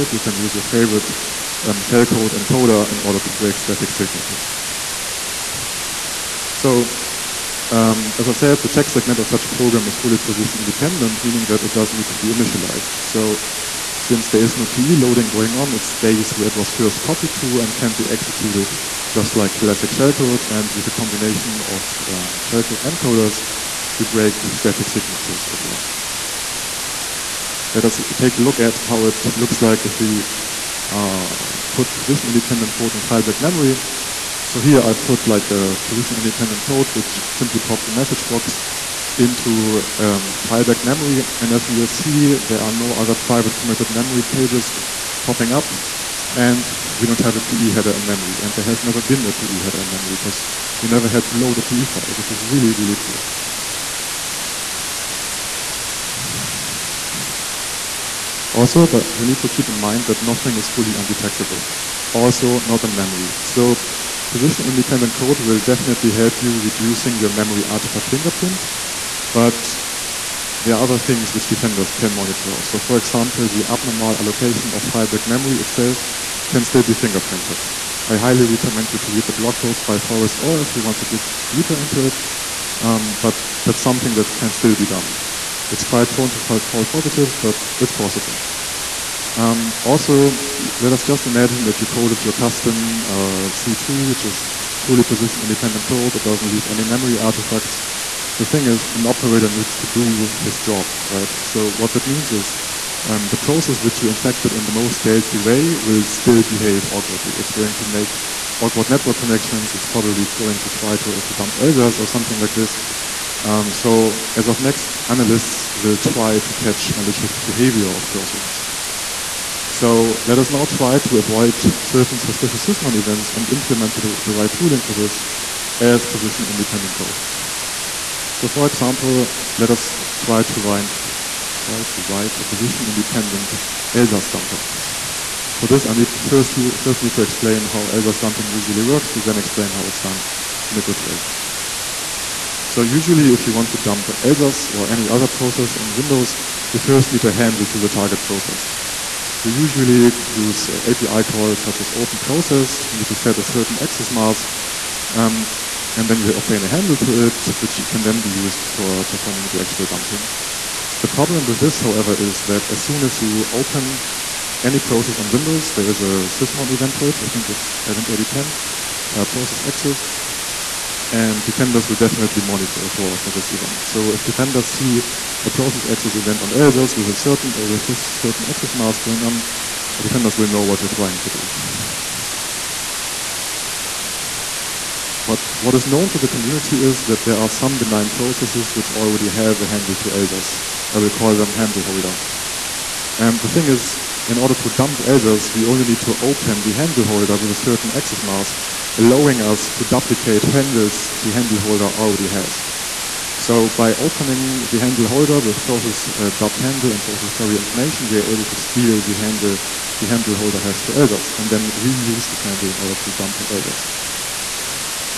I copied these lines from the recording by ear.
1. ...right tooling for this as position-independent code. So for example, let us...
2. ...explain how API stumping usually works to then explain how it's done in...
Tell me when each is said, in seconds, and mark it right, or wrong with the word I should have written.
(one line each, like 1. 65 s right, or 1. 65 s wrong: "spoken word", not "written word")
1. 124 s right
2. 137 s wrong: "ELSA", not "API".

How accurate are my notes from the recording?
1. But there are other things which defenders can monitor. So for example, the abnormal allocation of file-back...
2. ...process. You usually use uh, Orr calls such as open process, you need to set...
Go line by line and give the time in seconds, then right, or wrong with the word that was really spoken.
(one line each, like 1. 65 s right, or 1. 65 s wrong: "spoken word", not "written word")
1. 69 s right
2. 148 s wrong: "API", not "Orr".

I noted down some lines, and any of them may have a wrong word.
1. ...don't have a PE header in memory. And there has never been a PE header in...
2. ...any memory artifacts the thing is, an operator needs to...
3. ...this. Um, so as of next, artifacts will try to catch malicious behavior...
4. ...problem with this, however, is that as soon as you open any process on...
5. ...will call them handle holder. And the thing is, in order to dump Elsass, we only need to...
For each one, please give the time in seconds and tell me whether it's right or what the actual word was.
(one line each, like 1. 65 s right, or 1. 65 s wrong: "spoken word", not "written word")
1. 47 s right
2. 96 s right
3. 112 s wrong: "analysts", not "artifacts"
4. 161 s right
5. 190 s right.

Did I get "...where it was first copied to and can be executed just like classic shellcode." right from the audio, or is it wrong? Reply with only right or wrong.
right.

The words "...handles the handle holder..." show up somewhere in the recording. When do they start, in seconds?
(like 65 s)
200 s.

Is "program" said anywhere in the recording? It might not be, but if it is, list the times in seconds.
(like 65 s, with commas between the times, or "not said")
9 s.